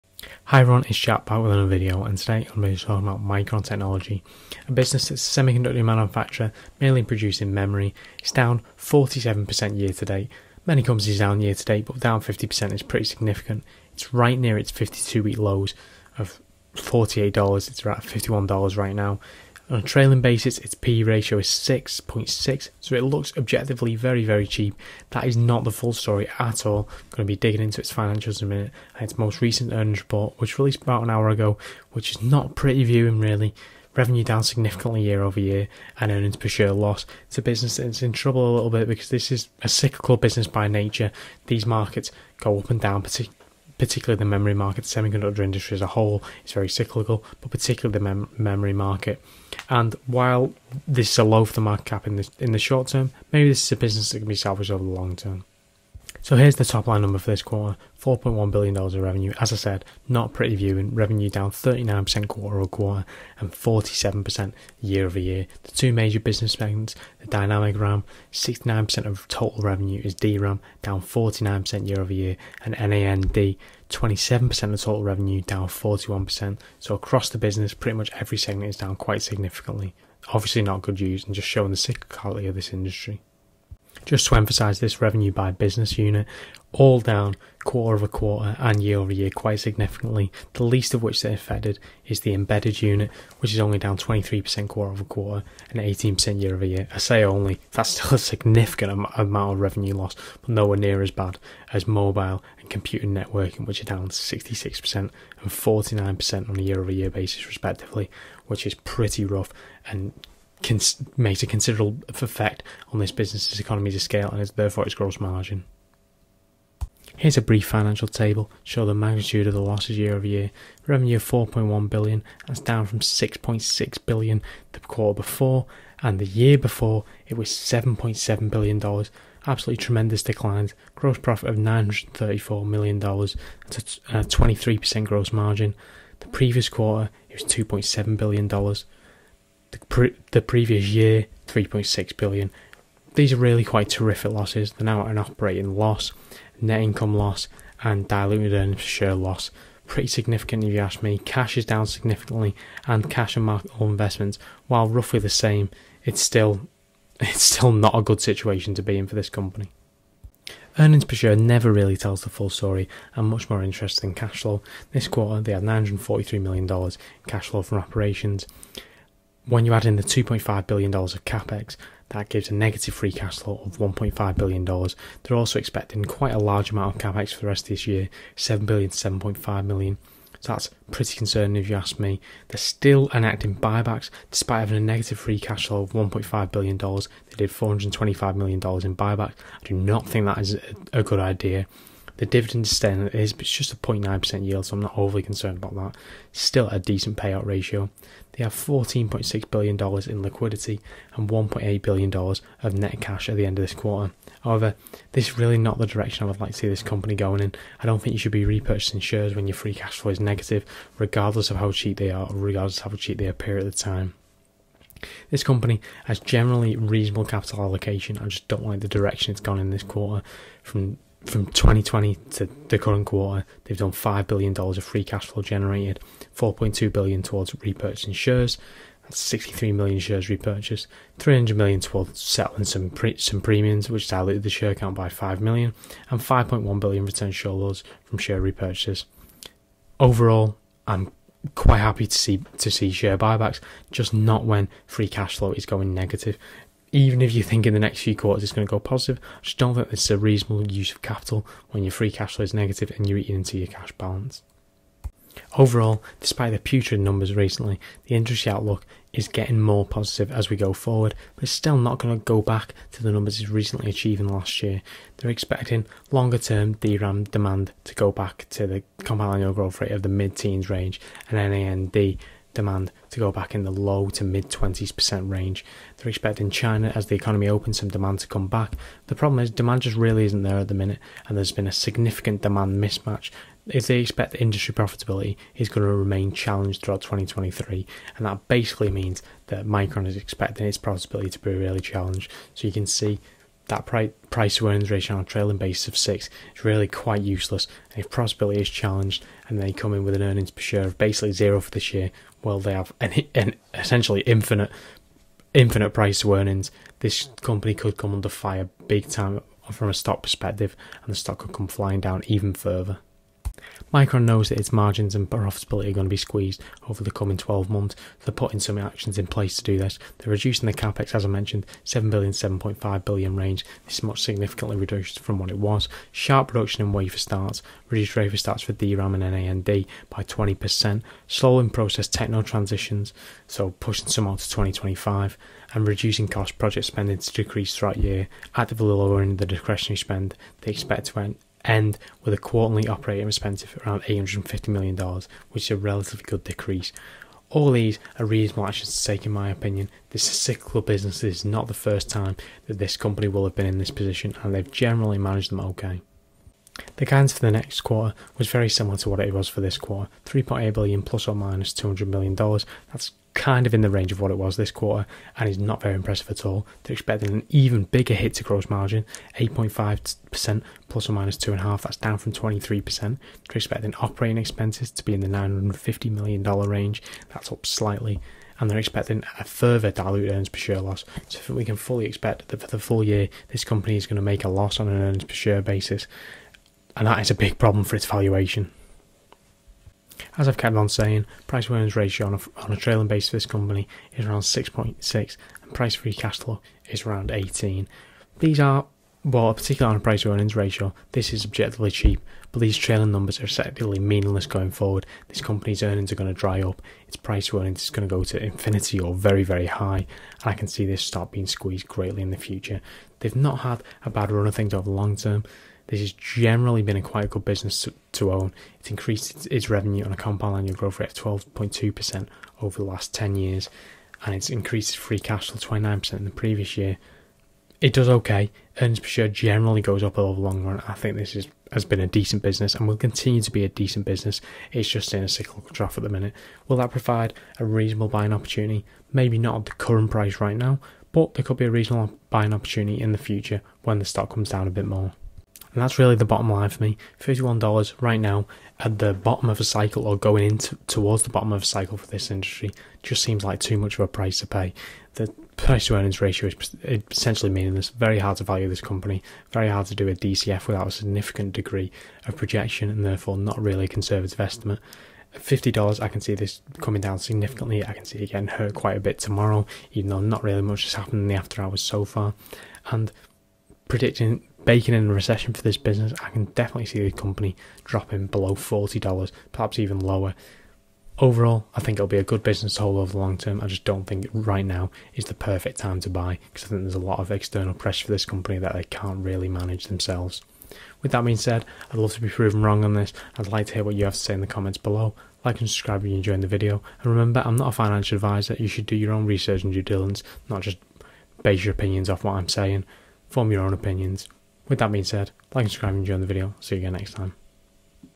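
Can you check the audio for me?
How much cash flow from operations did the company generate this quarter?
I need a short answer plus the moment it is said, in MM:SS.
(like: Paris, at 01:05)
$943 million, at 02:45.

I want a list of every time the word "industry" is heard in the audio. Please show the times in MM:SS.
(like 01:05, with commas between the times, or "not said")
00:45, 01:22, 04:18, 04:44, 07:32.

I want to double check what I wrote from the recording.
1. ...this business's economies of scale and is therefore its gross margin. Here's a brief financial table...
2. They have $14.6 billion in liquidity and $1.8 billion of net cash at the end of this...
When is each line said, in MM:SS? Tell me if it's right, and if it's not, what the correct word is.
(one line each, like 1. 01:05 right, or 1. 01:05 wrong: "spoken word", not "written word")
1. 01:52 right
2. 03:18 right.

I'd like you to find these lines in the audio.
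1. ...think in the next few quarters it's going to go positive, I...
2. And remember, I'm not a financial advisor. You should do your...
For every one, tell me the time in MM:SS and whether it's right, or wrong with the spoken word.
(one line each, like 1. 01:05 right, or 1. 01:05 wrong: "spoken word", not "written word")
1. 04:07 right
2. 08:17 right.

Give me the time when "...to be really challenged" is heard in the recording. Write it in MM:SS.
04:51.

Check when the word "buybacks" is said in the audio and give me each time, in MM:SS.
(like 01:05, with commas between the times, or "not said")
03:03, 03:08, 04:03.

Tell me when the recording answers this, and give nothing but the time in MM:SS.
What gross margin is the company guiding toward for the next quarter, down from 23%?
06:09.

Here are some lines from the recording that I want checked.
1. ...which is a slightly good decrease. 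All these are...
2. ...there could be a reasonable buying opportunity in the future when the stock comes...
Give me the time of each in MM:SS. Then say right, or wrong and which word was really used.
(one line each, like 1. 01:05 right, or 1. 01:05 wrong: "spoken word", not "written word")
1. 05:45 wrong: "relatively", not "slightly"
2. 07:21 right.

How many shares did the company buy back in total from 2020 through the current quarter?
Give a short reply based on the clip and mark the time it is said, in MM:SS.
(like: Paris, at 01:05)
63 million, at 03:49.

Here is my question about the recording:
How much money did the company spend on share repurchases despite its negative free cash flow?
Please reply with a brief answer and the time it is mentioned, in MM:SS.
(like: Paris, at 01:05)
$425 million, at 03:07.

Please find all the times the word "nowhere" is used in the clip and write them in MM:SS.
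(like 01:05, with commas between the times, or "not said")
01:40.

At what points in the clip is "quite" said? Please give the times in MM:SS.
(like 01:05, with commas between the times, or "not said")
01:18, 01:29, 02:23, 02:56, 04:01, 04:56, 06:57, 07:48.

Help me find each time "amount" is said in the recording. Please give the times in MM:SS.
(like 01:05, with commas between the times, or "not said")
01:39, 02:56.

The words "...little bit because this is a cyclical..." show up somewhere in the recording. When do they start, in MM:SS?
00:38.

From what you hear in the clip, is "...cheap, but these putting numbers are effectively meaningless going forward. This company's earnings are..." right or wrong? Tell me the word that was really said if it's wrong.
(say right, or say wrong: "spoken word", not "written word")
wrong: "trailing", not "putting".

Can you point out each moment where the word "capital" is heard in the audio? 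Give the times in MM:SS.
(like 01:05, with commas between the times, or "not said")
03:37, 04:11.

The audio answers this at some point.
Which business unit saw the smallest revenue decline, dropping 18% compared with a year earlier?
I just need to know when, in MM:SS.
01:32.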